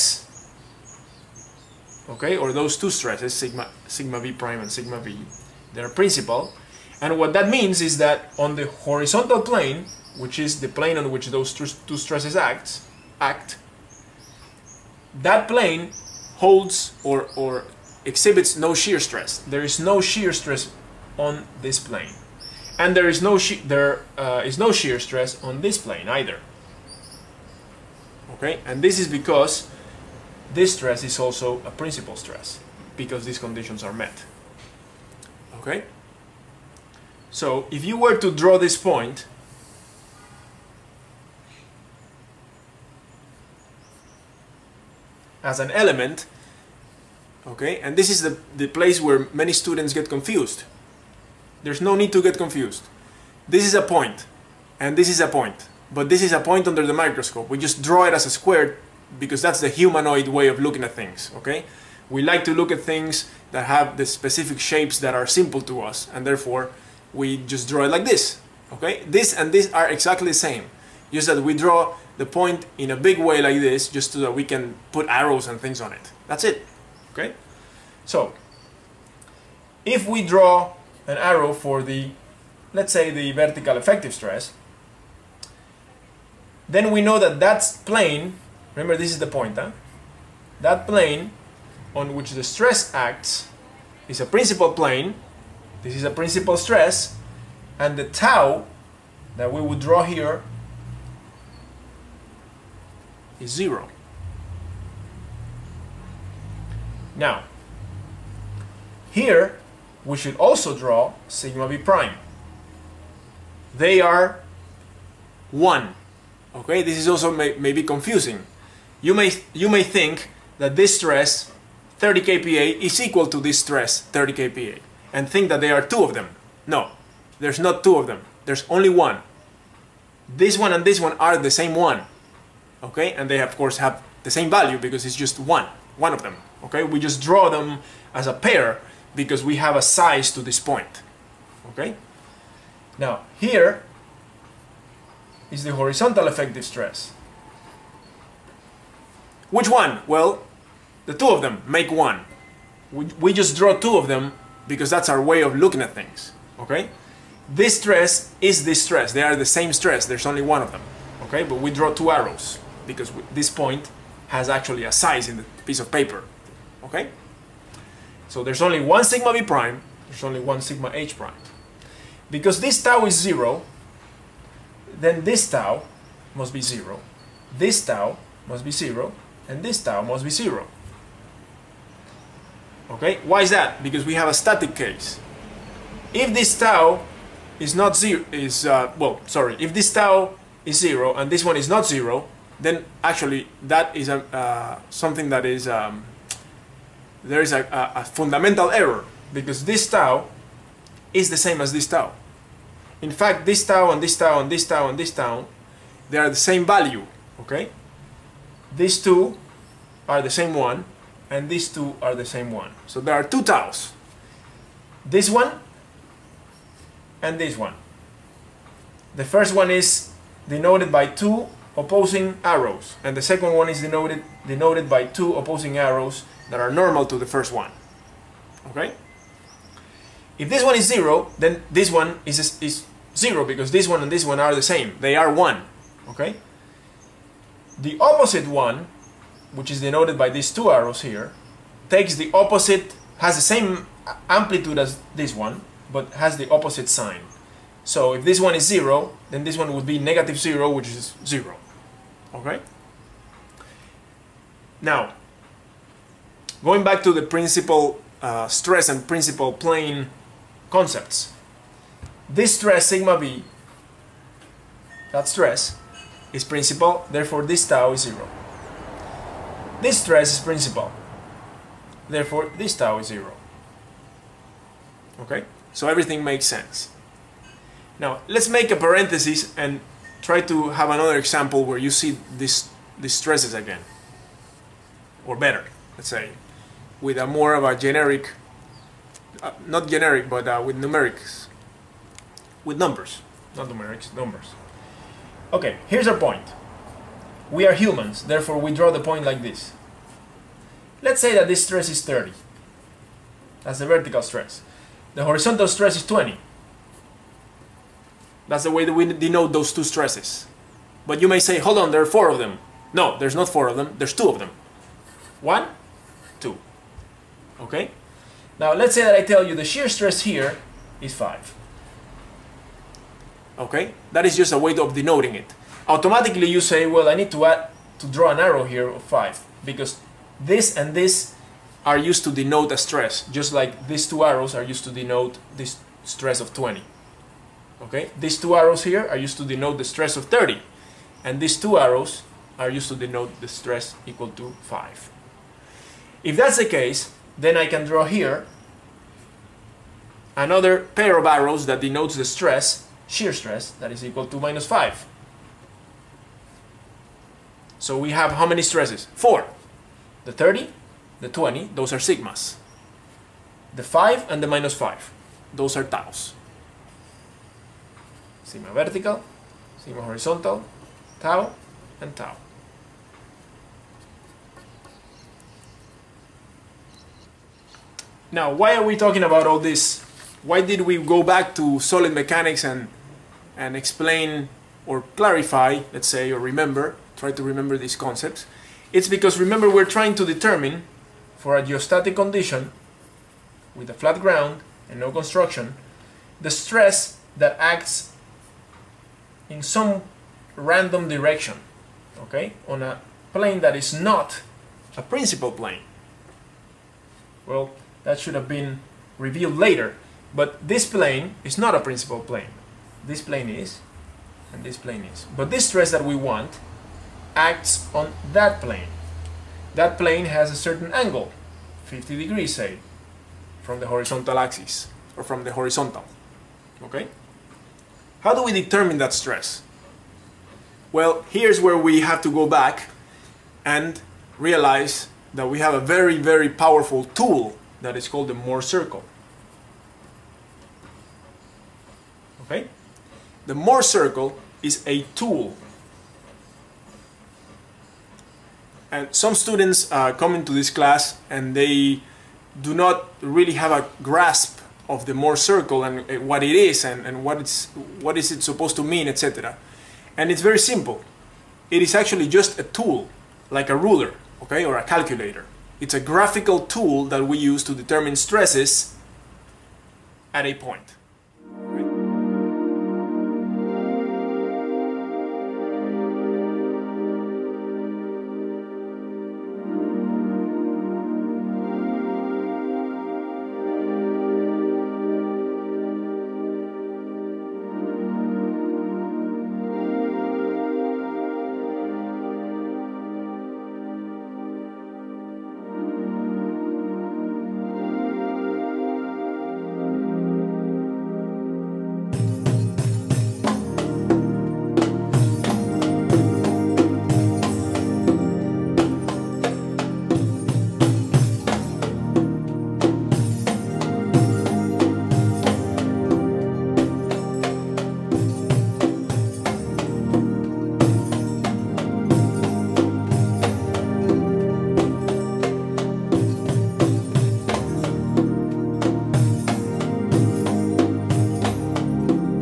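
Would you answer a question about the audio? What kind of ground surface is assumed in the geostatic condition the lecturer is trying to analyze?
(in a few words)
flat ground.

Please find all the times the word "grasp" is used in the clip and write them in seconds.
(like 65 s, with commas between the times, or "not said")
454 s.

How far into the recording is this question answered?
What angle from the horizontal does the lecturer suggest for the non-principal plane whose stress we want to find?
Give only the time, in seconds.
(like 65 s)
421 s.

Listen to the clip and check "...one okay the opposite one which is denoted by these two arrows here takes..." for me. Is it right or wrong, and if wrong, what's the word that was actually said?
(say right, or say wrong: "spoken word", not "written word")
right.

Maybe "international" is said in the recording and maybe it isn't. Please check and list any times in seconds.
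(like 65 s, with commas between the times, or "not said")
not said.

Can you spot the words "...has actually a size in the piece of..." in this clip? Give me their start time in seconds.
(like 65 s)
164 s.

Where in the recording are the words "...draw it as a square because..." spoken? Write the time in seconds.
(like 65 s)
57 s.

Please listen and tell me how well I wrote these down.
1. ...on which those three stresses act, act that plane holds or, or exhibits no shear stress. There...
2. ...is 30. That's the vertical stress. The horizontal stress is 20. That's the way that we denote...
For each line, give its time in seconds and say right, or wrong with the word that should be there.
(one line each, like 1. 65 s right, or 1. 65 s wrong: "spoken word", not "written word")
1. 10 s wrong: "two", not "three"
2. 301 s right.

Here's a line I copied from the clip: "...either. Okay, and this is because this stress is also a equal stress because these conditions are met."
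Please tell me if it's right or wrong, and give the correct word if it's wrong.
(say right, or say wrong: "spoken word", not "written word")
wrong: "principal", not "equal".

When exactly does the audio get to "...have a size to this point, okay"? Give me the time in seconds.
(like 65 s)
139 s.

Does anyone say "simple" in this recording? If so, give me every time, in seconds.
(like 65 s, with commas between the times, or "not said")
65 s, 460 s.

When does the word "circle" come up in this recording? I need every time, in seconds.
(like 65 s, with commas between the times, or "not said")
438 s, 443 s, 455 s.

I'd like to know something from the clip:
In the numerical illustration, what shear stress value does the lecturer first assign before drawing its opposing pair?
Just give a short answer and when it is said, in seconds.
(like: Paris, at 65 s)
5, at 319 s.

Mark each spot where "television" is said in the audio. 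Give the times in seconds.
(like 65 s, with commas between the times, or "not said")
not said.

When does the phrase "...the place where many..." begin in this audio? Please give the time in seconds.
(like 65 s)
48 s.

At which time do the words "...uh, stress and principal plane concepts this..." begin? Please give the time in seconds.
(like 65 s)
258 s.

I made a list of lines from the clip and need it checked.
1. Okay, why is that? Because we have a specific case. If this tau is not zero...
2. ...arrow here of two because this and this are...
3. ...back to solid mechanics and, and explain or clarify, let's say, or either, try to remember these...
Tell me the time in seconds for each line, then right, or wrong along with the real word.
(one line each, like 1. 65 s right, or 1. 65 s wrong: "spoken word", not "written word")
1. 182 s wrong: "static", not "specific"
2. 328 s wrong: "five", not "two"
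3. 381 s wrong: "remember", not "either".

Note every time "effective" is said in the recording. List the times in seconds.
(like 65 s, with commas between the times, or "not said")
83 s, 146 s.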